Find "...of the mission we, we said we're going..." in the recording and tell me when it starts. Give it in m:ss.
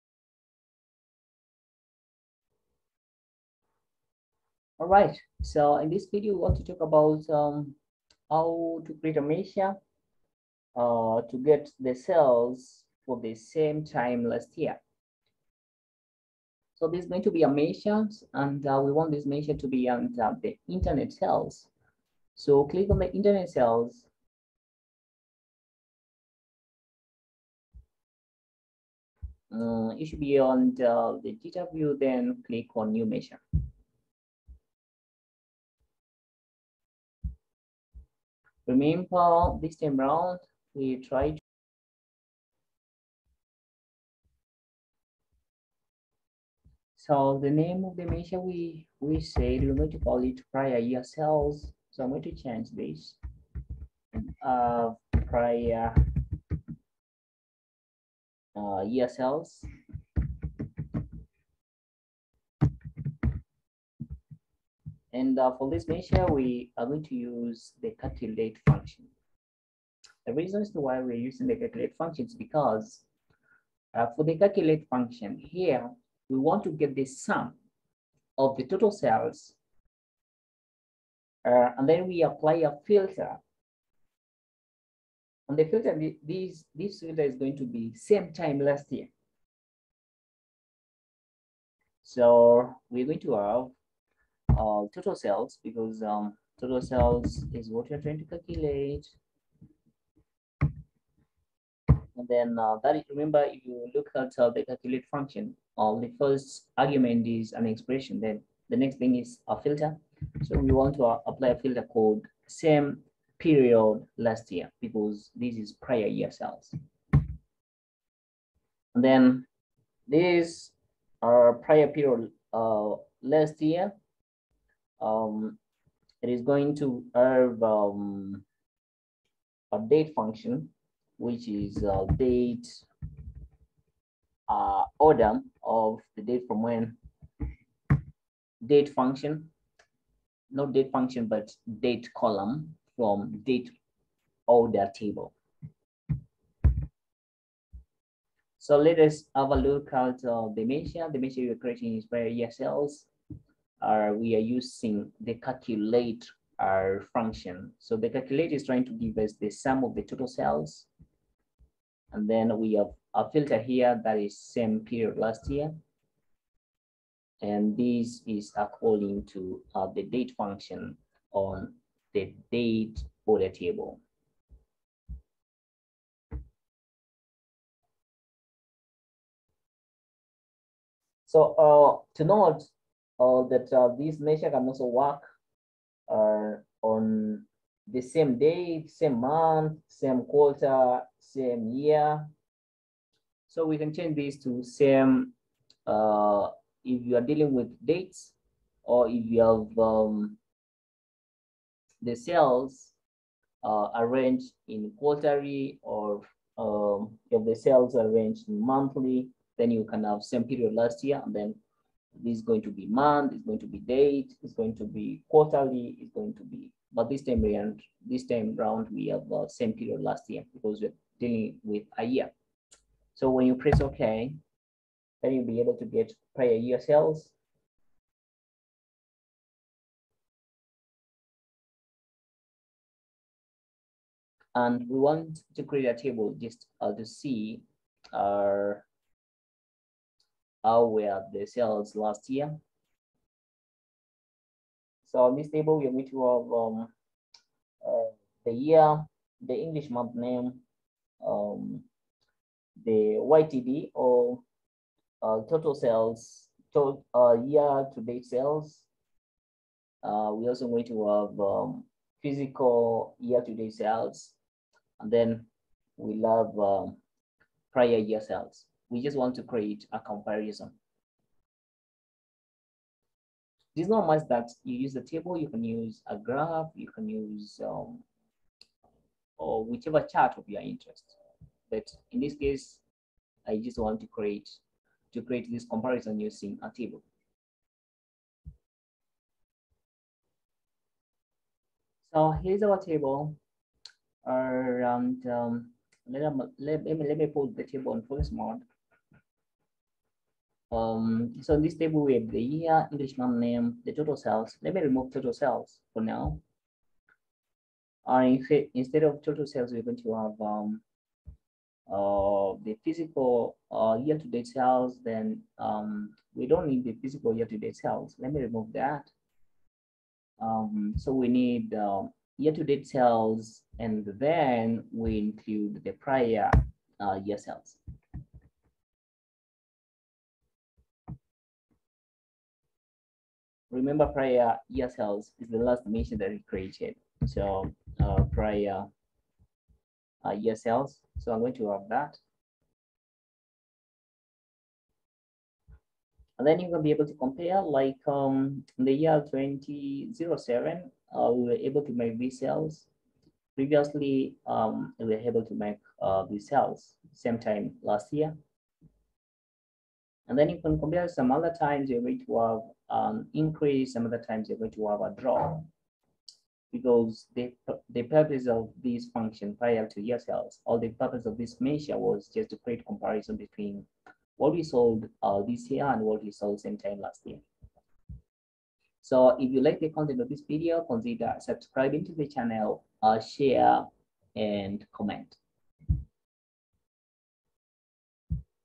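0:47.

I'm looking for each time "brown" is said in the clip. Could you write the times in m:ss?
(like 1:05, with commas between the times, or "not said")
not said.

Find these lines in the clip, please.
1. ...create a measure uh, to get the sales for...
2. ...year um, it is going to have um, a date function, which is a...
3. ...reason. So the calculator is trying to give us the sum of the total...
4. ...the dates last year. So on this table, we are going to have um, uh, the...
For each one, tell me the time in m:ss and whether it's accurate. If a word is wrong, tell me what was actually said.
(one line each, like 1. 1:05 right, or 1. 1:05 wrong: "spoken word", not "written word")
1. 0:08 right
2. 2:03 right
3. 2:37 wrong: "function", not "reason"
4. 4:01 wrong: "sales", not "dates".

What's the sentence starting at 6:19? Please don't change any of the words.
So if you like the content of this video, consider subscribing to the channel, uh, share, and comment.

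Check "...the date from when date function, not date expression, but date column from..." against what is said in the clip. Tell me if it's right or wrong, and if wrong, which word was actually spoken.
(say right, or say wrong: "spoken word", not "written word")
wrong: "function", not "expression".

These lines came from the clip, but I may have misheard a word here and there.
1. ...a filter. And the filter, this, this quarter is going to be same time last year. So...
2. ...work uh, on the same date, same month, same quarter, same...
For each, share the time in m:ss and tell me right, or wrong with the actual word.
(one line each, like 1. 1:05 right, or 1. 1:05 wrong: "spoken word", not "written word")
1. 1:22 wrong: "filter", not "quarter"
2. 3:04 right.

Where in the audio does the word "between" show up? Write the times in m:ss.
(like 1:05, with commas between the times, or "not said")
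6:13.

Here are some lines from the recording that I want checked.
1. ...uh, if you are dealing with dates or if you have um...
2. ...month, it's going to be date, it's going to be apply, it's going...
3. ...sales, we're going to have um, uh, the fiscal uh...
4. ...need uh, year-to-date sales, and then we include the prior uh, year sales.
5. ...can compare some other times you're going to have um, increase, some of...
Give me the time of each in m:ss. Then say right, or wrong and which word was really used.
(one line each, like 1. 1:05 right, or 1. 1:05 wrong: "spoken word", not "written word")
1. 3:15 right
2. 3:32 wrong: "quarterly", not "apply"
3. 5:09 right
4. 5:21 right
5. 6:00 right.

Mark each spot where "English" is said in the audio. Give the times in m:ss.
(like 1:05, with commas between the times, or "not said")
4:09, 5:02.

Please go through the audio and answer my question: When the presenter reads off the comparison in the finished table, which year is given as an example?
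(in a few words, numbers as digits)
2007.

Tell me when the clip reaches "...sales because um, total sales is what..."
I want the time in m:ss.
1:35.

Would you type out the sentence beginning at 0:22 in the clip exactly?
So click on the internet sales.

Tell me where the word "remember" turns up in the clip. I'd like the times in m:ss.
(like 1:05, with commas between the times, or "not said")
0:38, 1:43, 5:33.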